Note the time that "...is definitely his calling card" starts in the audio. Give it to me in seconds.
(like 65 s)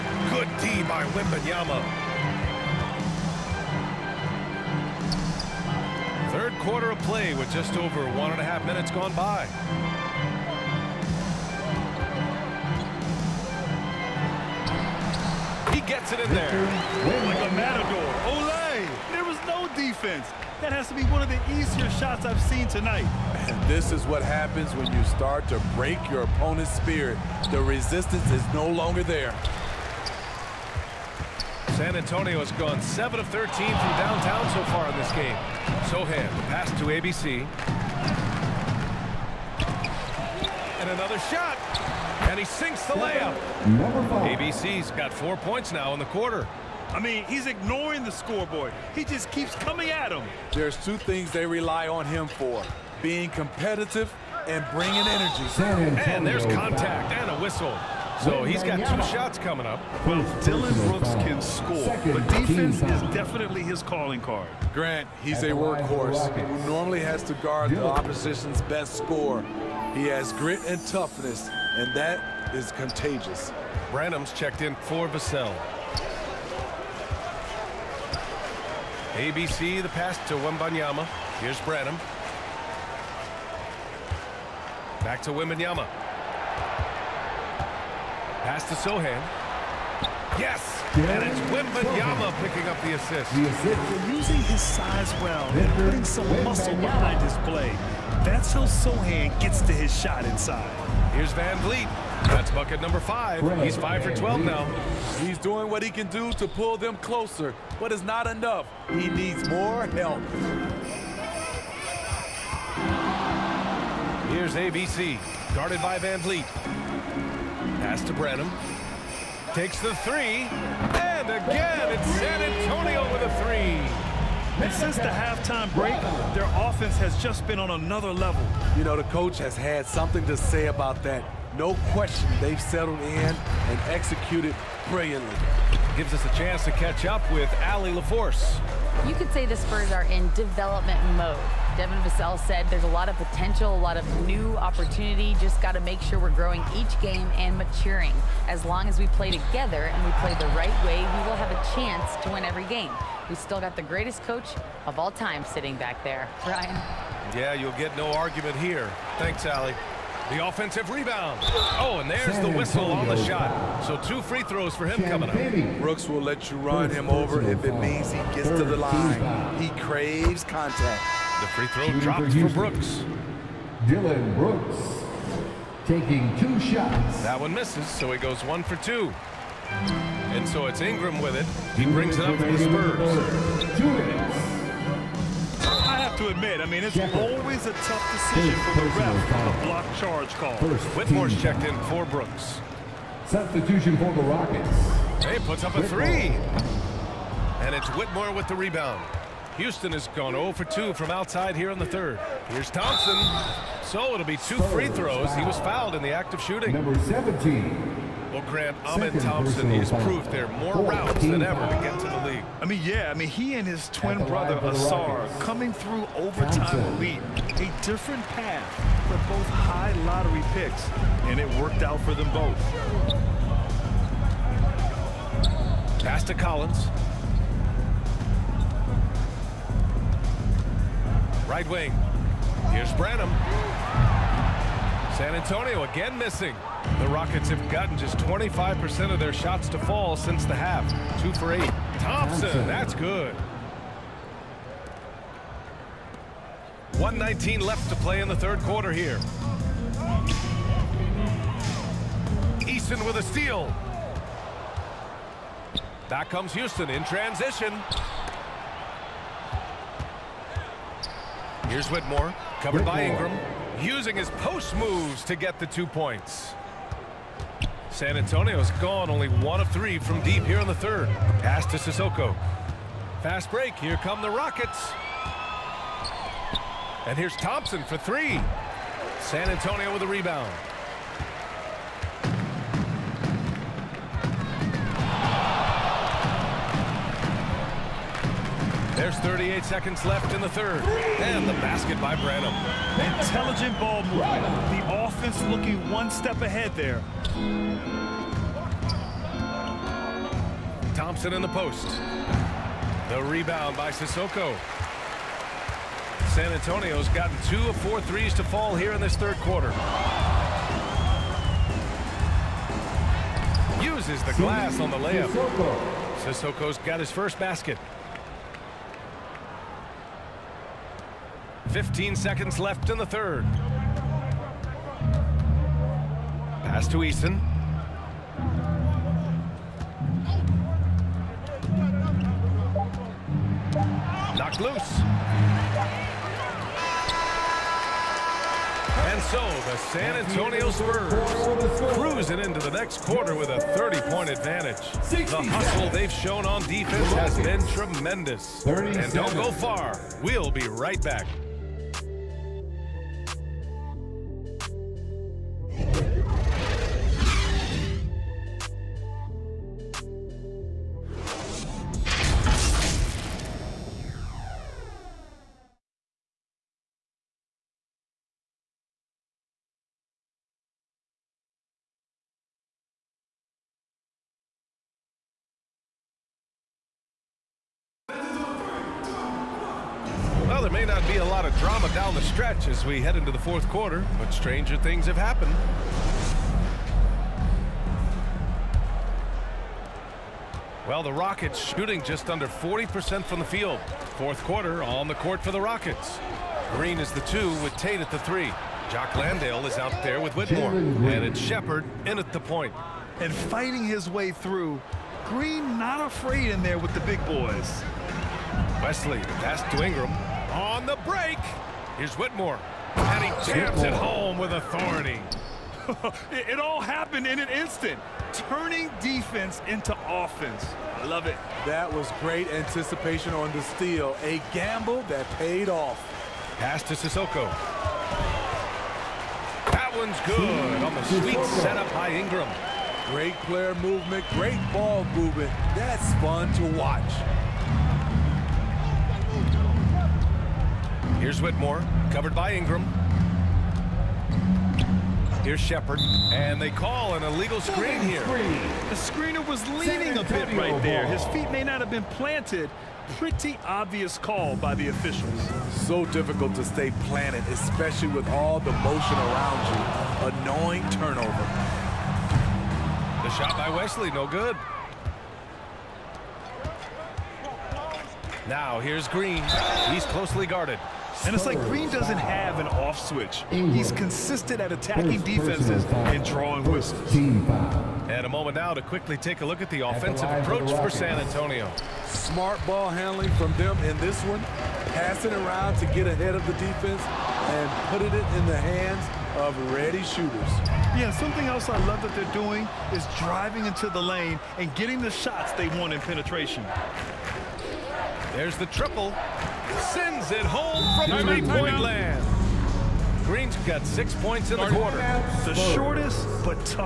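62 s.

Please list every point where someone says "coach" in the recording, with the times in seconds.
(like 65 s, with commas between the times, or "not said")
129 s, 154 s.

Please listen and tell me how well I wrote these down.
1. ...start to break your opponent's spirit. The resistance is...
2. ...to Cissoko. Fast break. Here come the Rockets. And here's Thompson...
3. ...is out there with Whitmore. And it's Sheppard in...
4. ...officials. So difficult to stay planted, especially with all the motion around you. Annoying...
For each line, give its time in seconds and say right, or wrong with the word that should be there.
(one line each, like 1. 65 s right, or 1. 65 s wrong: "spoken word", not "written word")
1. 25 s right
2. 271 s right
3. 399 s right
4. 454 s right.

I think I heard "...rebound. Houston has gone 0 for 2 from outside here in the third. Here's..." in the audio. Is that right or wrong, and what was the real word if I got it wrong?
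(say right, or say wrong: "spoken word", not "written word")
right.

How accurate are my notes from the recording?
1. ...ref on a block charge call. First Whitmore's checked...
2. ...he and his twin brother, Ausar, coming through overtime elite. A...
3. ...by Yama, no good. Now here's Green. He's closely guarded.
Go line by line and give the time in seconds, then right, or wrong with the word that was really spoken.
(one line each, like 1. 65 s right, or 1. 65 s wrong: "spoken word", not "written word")
1. 188 s right
2. 213 s right
3. 463 s wrong: "Wesley", not "Yama".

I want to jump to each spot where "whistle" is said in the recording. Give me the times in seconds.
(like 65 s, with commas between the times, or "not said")
57 s, 162 s, 476 s.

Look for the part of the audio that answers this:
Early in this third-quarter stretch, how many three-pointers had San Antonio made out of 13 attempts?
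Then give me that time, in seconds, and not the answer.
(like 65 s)
32 s.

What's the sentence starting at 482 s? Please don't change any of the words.
Smart ball handling from them in this one.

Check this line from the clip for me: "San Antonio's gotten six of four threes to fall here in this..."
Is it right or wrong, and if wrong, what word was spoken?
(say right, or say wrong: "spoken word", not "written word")
wrong: "two", not "six".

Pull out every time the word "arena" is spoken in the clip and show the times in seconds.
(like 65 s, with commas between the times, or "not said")
not said.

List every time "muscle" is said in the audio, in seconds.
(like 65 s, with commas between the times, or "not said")
96 s.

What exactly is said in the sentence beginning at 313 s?
Uses the glass on the layup.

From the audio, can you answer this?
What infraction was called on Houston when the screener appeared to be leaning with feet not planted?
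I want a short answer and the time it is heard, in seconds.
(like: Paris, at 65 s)
Illegal screen, at 447 s.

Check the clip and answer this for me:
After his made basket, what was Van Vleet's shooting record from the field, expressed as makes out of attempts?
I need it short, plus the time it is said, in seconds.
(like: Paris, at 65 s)
5 for 12, at 103 s.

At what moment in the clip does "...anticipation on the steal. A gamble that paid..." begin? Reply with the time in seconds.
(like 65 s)
422 s.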